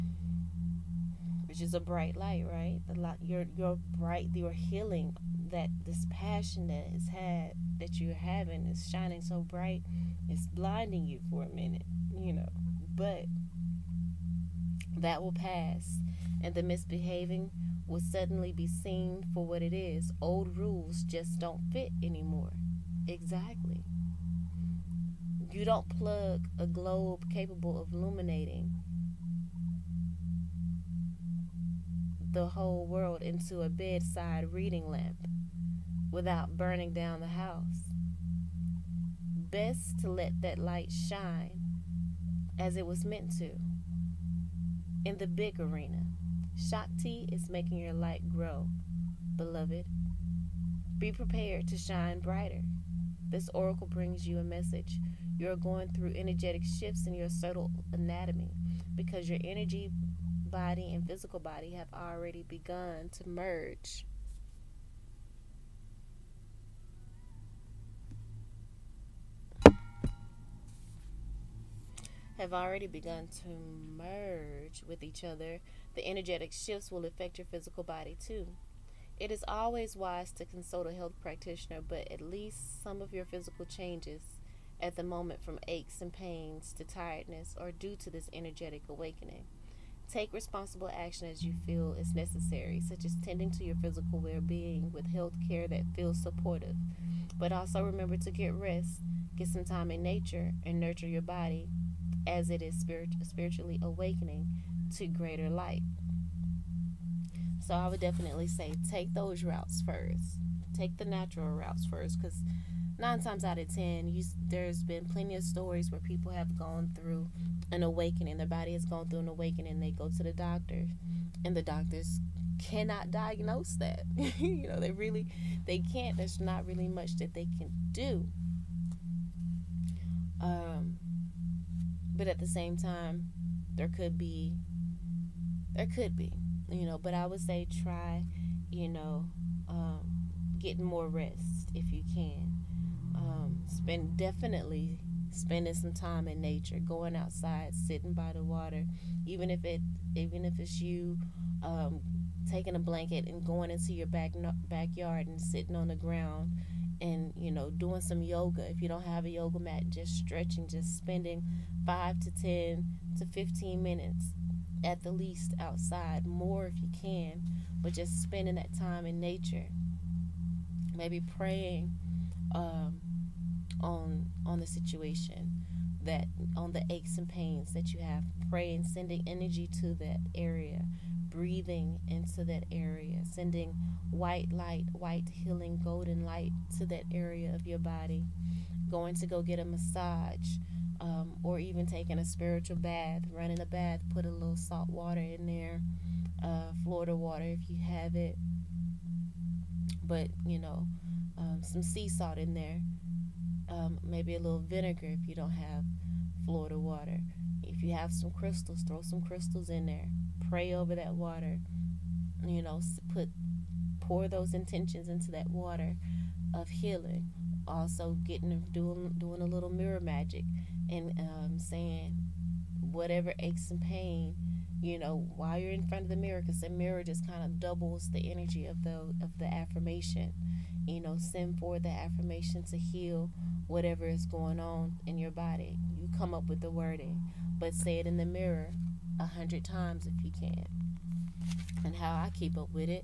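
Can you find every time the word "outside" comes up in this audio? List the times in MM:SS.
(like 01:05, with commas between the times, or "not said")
02:27, 02:45.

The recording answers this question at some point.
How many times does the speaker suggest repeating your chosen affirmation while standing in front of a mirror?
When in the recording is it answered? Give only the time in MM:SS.
03:59.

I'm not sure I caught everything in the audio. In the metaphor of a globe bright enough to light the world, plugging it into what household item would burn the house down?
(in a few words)
bedside reading lamp.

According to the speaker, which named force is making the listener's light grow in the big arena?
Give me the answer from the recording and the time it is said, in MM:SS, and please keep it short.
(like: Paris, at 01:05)
Shakti, at 00:46.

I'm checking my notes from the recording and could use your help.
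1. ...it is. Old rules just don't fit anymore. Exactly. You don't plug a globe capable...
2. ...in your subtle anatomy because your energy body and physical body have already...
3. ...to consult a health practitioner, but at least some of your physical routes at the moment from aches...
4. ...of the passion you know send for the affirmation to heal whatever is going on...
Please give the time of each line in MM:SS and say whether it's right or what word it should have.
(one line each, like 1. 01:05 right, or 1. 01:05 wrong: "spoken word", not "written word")
1. 00:19 right
2. 00:57 right
3. 01:20 wrong: "changes", not "routes"
4. 03:49 wrong: "affirmation", not "passion".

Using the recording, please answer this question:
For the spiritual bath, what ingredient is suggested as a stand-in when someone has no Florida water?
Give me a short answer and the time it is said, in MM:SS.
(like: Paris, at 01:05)
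vinegar, at 03:24.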